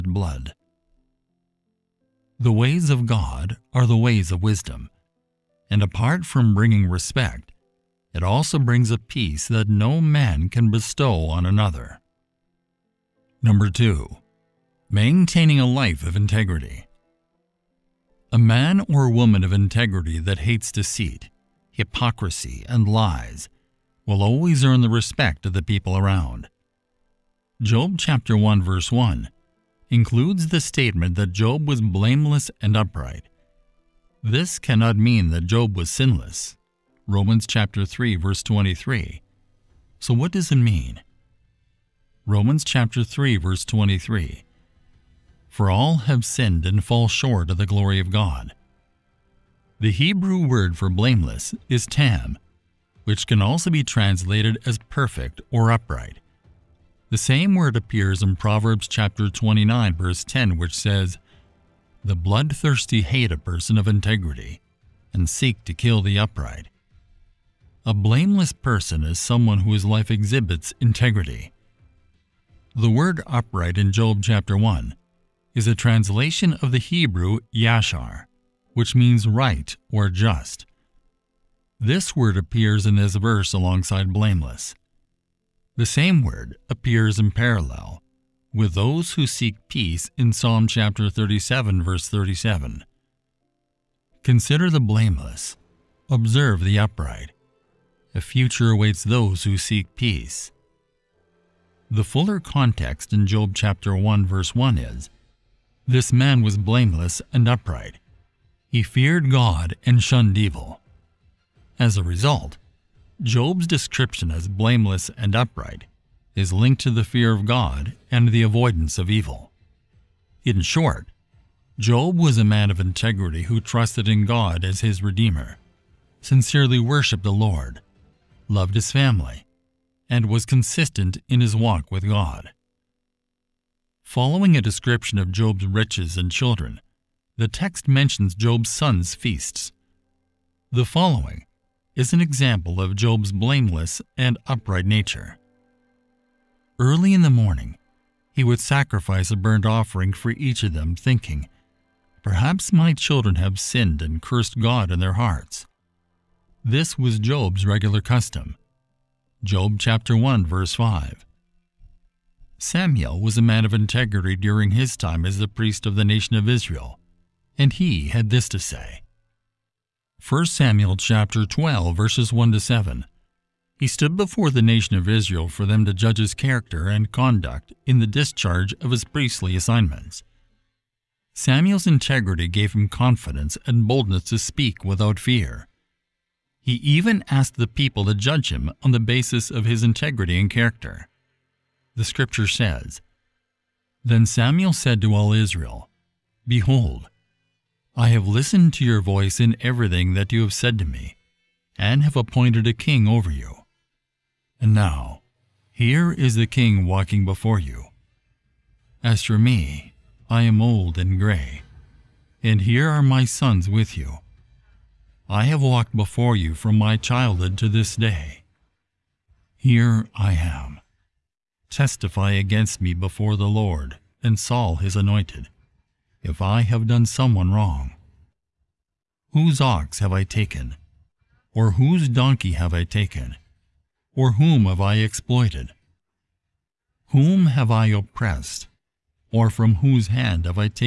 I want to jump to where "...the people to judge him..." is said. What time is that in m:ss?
3:07.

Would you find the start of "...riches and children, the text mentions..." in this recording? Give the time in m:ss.
2:15.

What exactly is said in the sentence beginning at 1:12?
The word upright in Job chapter 1 is a translation of the Hebrew yashar, which means right or just.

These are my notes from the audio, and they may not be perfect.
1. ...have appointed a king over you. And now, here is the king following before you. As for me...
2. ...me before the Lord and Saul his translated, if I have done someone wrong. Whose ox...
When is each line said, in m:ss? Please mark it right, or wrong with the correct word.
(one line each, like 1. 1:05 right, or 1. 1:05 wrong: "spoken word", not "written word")
1. 3:22 wrong: "walking", not "following"
2. 3:42 wrong: "anointed", not "translated".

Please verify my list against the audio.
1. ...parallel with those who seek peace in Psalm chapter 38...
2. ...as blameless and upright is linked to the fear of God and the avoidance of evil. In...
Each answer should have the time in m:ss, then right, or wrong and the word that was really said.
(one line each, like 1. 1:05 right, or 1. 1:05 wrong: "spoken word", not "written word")
1. 1:27 wrong: "37", not "38"
2. 1:54 right.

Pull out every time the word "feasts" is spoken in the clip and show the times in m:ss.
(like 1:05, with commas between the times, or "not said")
2:19.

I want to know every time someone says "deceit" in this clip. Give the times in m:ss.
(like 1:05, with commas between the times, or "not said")
0:20.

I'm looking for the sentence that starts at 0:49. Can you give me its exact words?
The Hebrew word for blameless is tam, which can also be translated as perfect or upright.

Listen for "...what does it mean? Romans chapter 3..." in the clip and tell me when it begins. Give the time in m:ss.
0:40.